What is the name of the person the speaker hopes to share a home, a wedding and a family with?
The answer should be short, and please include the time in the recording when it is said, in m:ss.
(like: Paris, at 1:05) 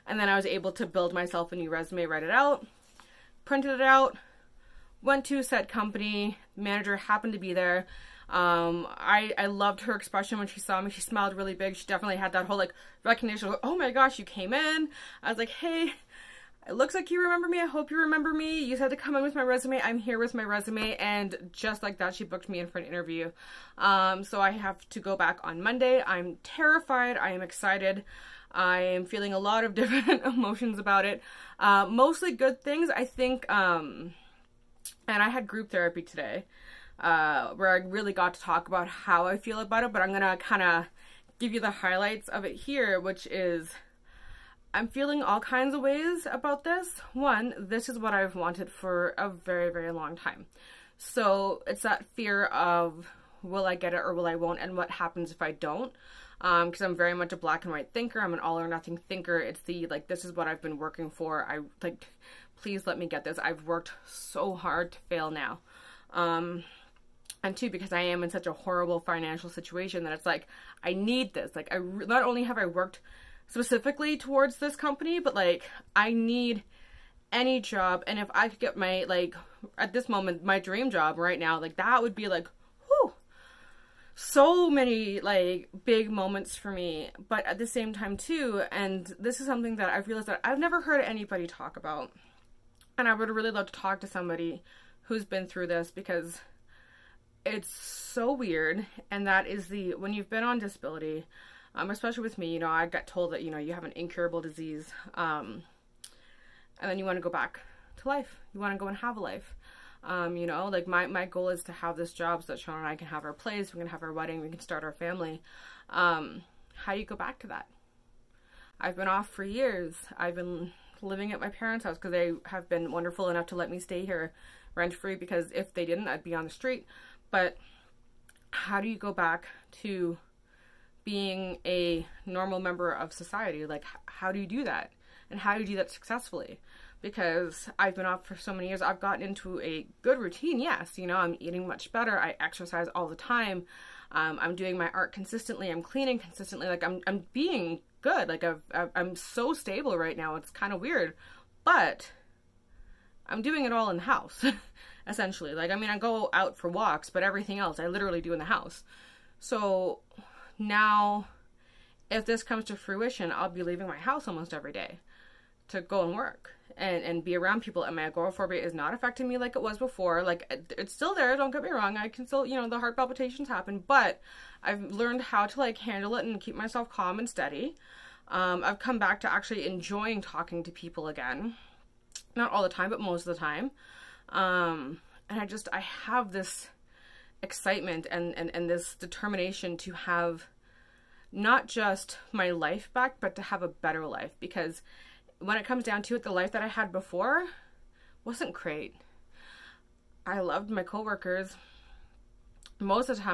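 Sean, at 1:52.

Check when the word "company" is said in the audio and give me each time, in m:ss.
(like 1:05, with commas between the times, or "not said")
0:05, 1:14.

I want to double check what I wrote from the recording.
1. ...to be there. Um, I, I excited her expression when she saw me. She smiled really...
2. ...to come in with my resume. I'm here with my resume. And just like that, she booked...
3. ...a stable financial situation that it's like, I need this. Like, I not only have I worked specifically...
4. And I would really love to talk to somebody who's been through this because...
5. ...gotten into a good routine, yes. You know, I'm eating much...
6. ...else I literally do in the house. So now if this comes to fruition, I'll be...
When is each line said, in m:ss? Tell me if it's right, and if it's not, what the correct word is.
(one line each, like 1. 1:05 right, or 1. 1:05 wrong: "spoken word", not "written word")
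1. 0:07 wrong: "loved", not "excited"
2. 0:18 right
3. 1:08 wrong: "horrible", not "stable"
4. 1:32 right
5. 2:18 right
6. 2:37 right.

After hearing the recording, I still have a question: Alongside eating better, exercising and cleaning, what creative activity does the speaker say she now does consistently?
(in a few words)
Art.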